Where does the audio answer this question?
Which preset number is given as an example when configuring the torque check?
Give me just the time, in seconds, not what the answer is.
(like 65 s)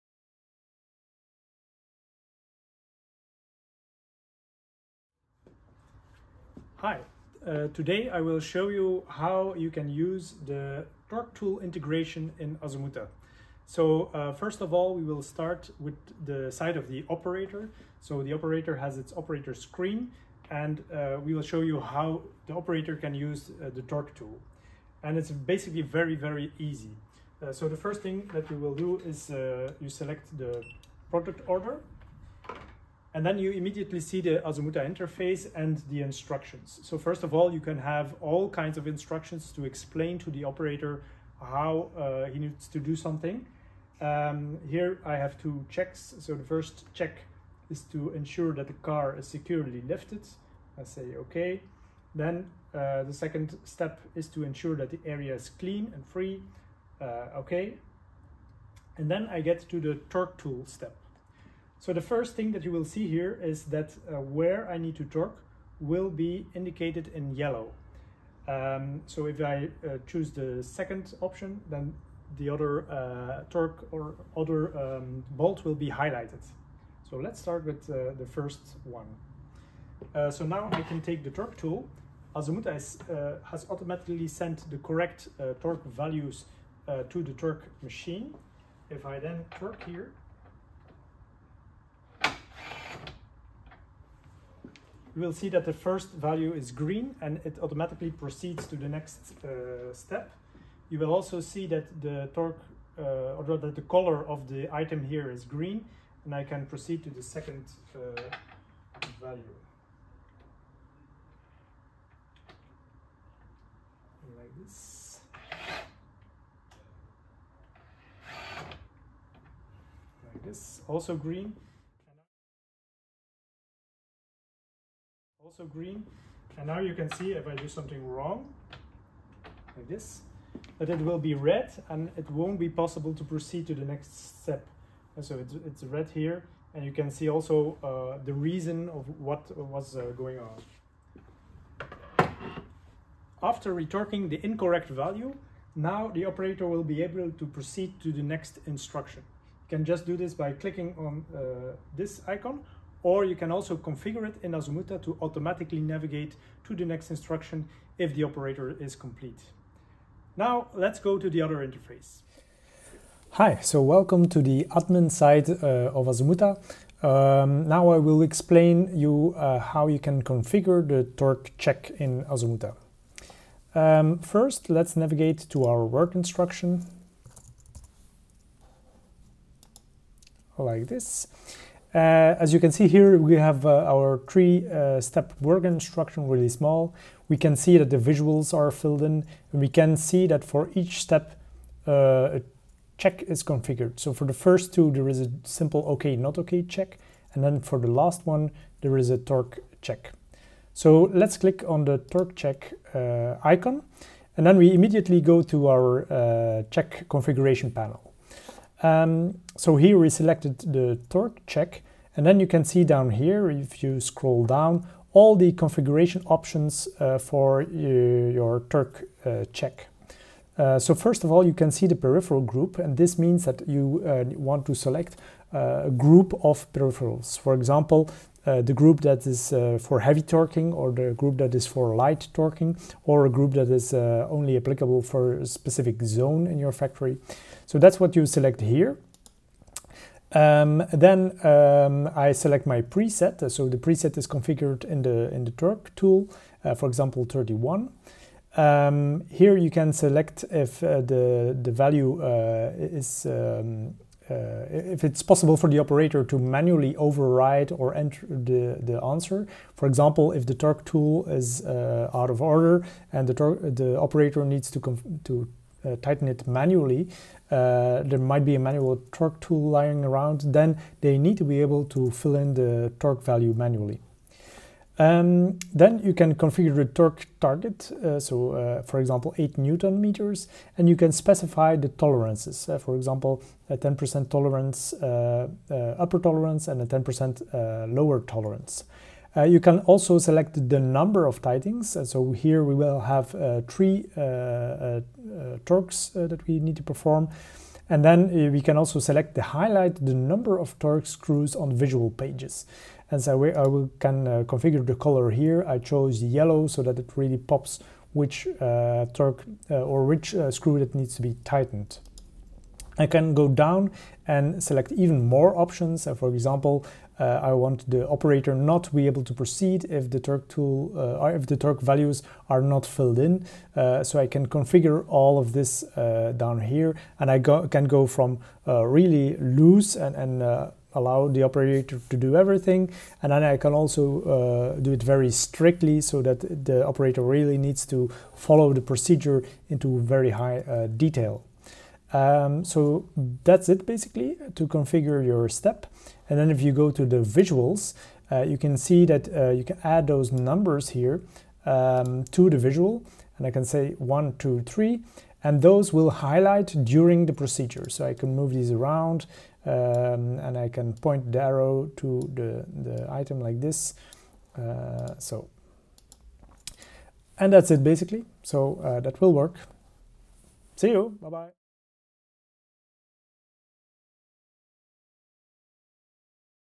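247 s.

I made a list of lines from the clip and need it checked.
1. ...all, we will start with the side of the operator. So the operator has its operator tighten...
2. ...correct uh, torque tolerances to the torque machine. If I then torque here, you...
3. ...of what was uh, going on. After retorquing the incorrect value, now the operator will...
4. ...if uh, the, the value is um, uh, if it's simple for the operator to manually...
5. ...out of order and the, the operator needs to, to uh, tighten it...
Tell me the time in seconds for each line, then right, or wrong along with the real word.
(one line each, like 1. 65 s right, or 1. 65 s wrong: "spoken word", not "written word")
1. 14 s wrong: "screen", not "tighten"
2. 84 s wrong: "values", not "tolerances"
3. 138 s right
4. 250 s wrong: "possible", not "simple"
5. 262 s right.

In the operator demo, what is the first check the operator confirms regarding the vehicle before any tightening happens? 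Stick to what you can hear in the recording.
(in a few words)
Car is securely lifted.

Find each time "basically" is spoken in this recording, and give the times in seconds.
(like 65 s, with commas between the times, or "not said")
25 s, 343 s, 367 s.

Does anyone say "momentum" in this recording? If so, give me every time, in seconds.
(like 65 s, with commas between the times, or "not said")
not said.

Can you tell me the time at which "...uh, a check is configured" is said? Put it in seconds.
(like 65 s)
191 s.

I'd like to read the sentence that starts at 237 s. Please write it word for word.
So that's what you select here.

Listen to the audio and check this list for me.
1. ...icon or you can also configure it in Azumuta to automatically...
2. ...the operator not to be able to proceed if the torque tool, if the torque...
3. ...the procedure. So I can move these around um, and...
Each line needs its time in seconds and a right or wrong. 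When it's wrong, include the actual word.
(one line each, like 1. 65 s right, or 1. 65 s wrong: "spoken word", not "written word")
1. 152 s right
2. 317 s right
3. 357 s right.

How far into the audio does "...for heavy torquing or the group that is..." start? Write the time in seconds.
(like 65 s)
229 s.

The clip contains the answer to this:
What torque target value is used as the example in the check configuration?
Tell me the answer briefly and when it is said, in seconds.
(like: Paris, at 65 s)
8 newton meters, at 279 s.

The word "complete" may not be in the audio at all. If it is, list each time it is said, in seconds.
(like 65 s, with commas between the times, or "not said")
158 s.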